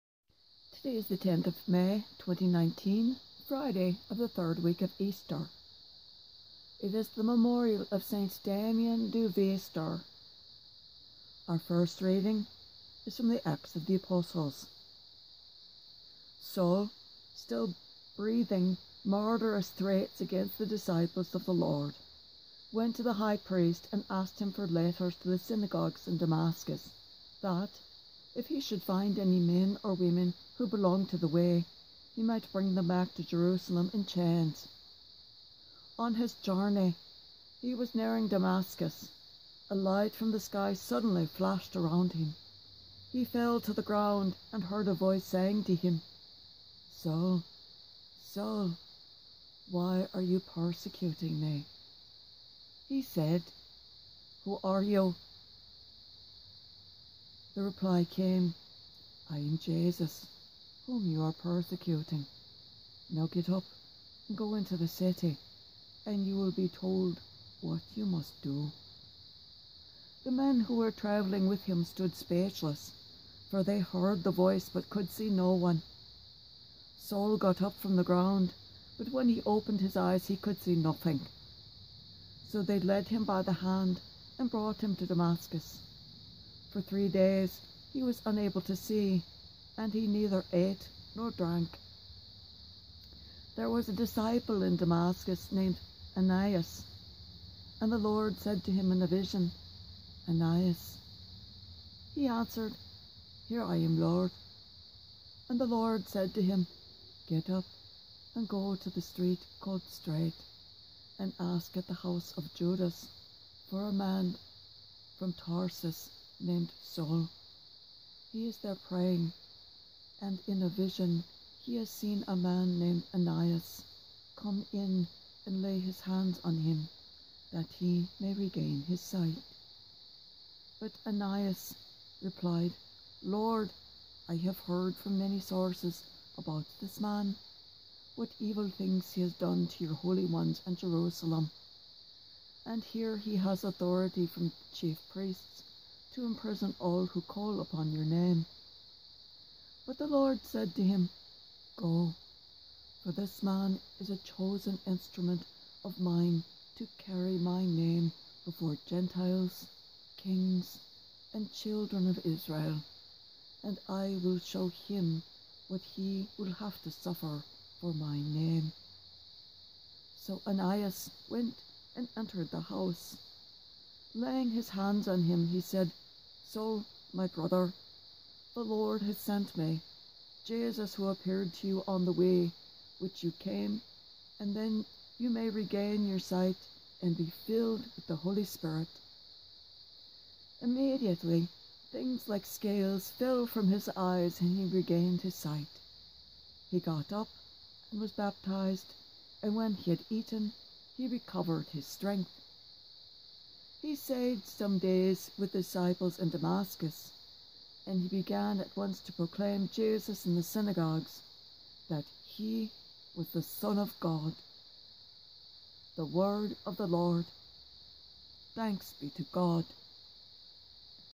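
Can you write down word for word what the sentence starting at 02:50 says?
So Ananias went and entered the house.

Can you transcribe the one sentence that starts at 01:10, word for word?
The men who were travelling with him stood speechless, for they heard the voice but could see no one.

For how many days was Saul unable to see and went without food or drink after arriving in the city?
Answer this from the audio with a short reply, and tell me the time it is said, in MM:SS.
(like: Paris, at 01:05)
3, at 01:26.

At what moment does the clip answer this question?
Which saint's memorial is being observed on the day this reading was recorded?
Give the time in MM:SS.
00:08.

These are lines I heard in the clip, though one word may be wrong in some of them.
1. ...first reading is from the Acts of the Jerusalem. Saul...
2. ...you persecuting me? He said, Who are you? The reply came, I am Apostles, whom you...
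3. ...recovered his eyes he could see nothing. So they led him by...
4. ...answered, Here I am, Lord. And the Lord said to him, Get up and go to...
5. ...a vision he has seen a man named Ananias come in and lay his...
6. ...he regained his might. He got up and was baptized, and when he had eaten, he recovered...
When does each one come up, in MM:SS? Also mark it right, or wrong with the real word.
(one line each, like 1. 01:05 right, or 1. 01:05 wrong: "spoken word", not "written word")
1. 00:11 wrong: "Apostles", not "Jerusalem"
2. 00:50 wrong: "Jesus", not "Apostles"
3. 01:19 wrong: "opened", not "recovered"
4. 01:42 right
5. 02:00 right
6. 03:14 wrong: "sight", not "might".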